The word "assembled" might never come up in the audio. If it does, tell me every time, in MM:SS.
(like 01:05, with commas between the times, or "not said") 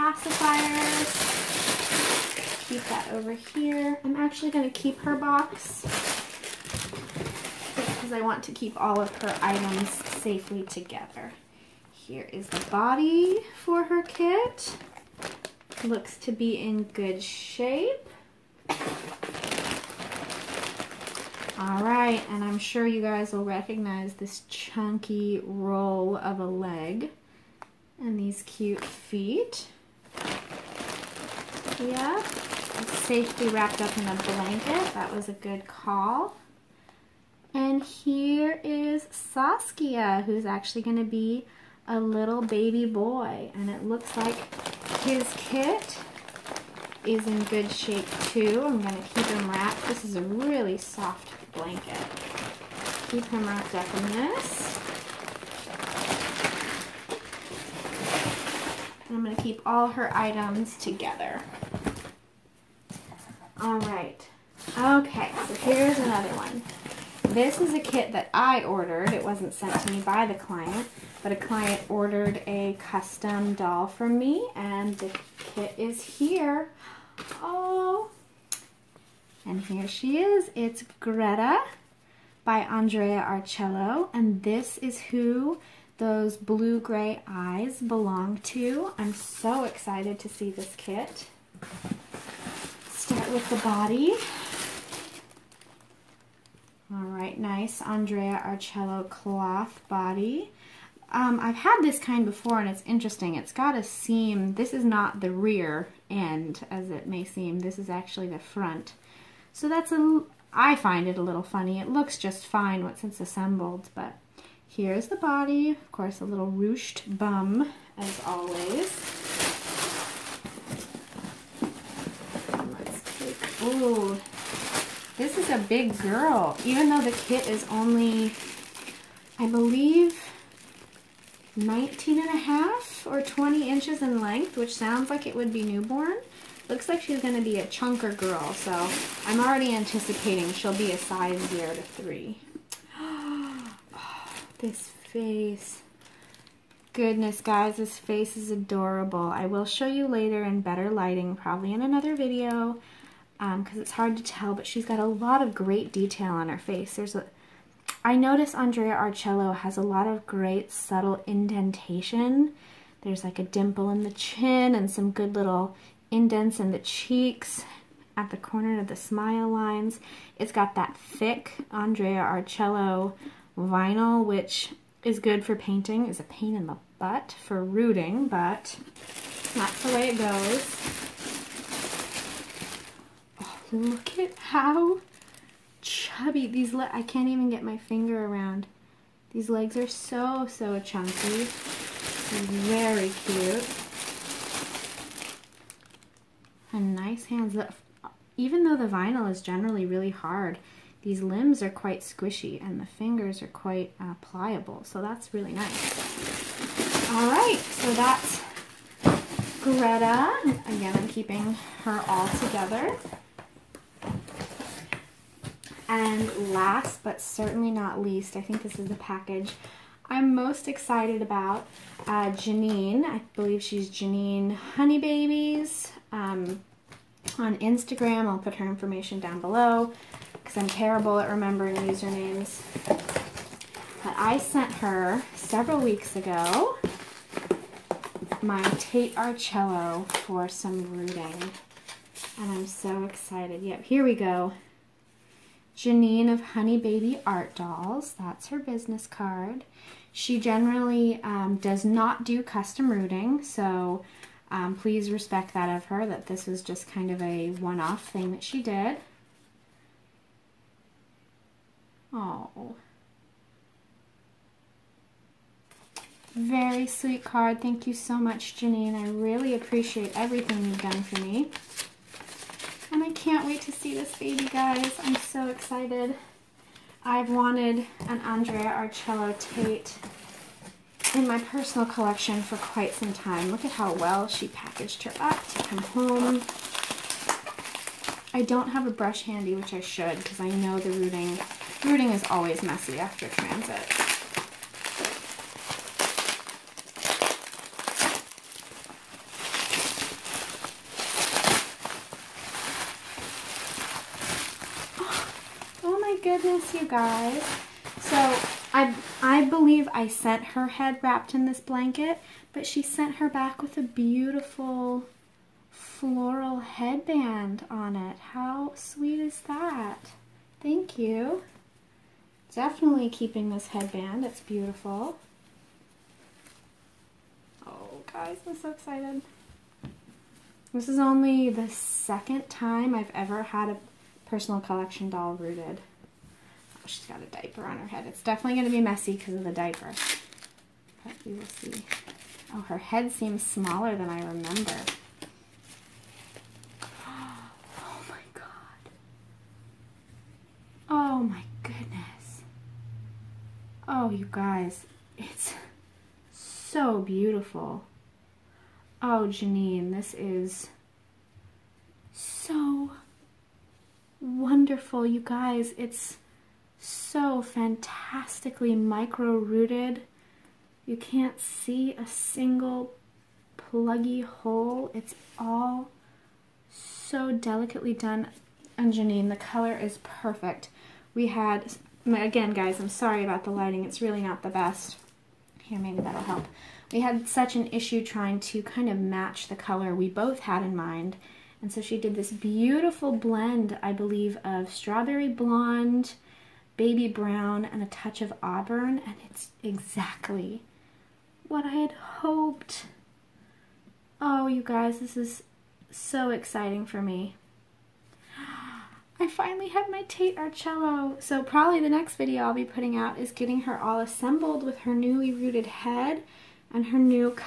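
01:53, 06:53.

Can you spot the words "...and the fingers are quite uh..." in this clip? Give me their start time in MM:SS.
03:22.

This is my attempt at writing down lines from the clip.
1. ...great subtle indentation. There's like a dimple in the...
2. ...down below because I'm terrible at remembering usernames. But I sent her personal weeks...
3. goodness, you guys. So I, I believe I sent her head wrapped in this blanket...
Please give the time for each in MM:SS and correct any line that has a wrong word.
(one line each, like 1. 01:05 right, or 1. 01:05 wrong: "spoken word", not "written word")
1. 02:40 right
2. 03:49 wrong: "several", not "personal"
3. 05:06 right.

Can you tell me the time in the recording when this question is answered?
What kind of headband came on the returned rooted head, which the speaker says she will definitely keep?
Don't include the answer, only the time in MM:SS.
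05:15.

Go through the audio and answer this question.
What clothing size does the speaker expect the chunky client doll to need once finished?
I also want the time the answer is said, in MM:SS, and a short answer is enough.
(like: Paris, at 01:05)
0 to 3, at 02:20.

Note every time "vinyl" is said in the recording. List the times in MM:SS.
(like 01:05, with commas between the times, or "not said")
02:53, 03:18.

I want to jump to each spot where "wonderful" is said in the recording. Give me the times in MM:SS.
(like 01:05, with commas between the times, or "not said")
06:04.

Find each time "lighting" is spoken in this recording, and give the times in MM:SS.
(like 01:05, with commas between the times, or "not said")
02:30, 06:23.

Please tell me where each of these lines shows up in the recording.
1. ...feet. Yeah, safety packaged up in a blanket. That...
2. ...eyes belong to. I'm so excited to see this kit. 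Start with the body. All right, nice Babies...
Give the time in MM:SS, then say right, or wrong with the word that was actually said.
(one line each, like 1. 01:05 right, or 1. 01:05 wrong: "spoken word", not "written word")
1. 00:28 wrong: "wrapped", not "packaged"
2. 01:27 wrong: "Andrea", not "Babies".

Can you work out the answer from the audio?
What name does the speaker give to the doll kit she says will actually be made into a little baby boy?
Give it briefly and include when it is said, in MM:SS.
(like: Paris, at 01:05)
Saskia, at 00:39.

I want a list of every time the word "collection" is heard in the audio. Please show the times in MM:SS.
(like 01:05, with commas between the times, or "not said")
04:41, 05:34.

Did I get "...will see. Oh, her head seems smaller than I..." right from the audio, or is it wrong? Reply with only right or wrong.
right.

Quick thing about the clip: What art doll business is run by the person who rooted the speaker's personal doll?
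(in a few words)
Hunnibaby Art Dolls.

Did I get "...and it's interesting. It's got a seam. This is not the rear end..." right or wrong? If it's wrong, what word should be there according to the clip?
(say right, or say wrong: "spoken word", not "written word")
right.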